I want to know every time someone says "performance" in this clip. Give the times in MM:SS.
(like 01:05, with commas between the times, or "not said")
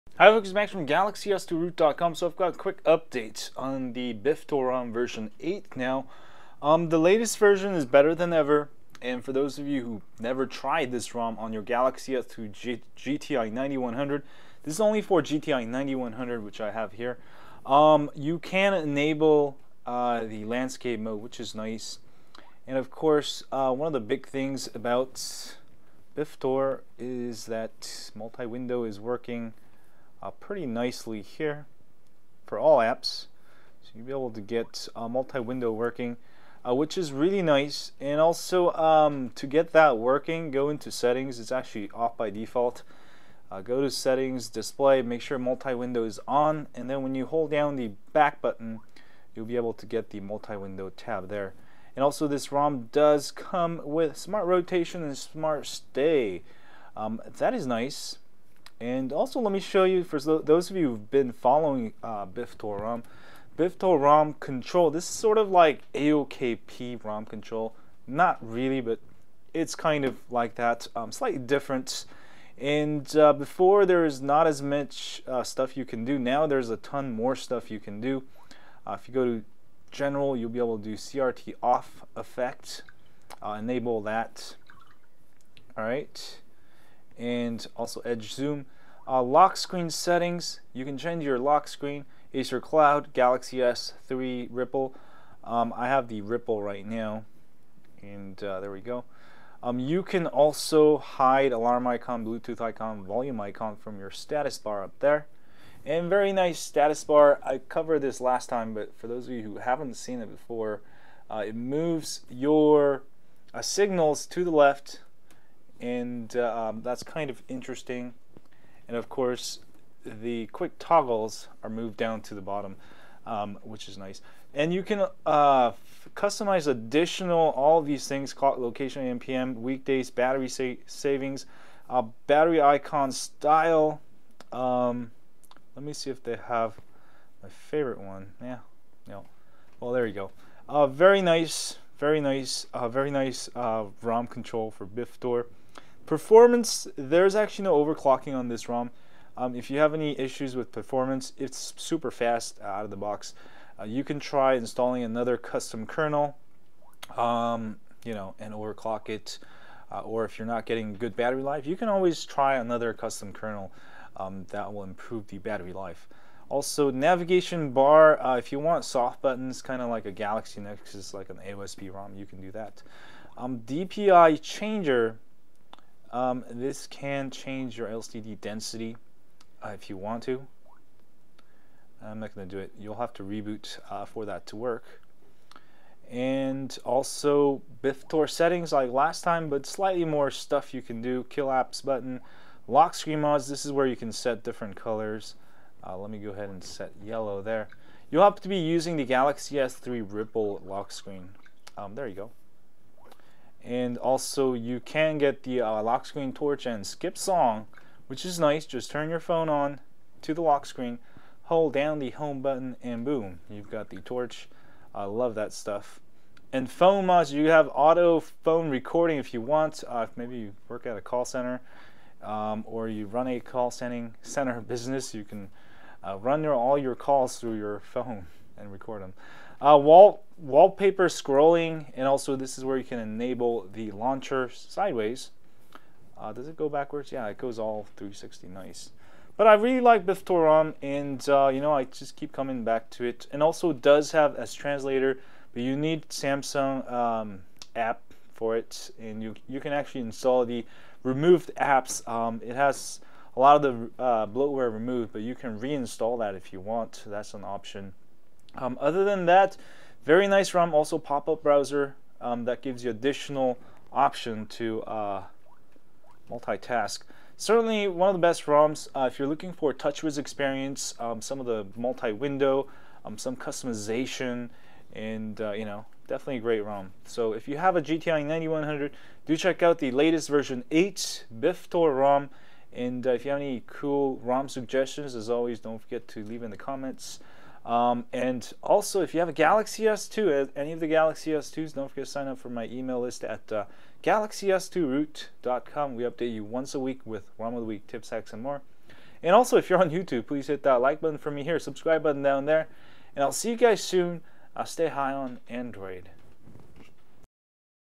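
02:26, 02:30.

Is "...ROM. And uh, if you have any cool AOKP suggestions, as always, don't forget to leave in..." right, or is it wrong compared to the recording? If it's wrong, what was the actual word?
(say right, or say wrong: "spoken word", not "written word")
wrong: "ROM", not "AOKP".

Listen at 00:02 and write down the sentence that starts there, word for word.
So I've got quick updates on the Biff version 8 now.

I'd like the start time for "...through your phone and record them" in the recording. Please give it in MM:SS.
03:47.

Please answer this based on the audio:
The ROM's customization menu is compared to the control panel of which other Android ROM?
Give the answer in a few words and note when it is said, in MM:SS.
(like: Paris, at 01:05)
AOKP, at 01:05.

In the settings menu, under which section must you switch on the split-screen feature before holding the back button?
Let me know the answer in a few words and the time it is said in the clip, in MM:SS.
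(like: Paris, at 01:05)
Display, at 00:44.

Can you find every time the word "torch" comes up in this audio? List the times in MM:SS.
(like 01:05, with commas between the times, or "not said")
03:26, 03:34.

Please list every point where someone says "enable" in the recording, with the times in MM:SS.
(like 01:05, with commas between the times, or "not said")
00:18, 01:23, 03:52.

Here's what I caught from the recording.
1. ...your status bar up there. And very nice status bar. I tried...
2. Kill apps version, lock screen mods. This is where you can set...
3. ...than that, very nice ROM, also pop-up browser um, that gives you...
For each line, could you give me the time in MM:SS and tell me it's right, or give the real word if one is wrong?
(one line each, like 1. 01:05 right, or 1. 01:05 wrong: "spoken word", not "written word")
1. 01:43 wrong: "covered", not "tried"
2. 03:11 wrong: "button", not "version"
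3. 04:19 right.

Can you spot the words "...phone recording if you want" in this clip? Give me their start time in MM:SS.
03:38.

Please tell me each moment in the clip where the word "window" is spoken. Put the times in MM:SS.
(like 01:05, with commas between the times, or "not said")
00:28, 00:35, 00:45, 00:50, 04:31.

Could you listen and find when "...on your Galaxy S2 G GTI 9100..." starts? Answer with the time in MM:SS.
00:11.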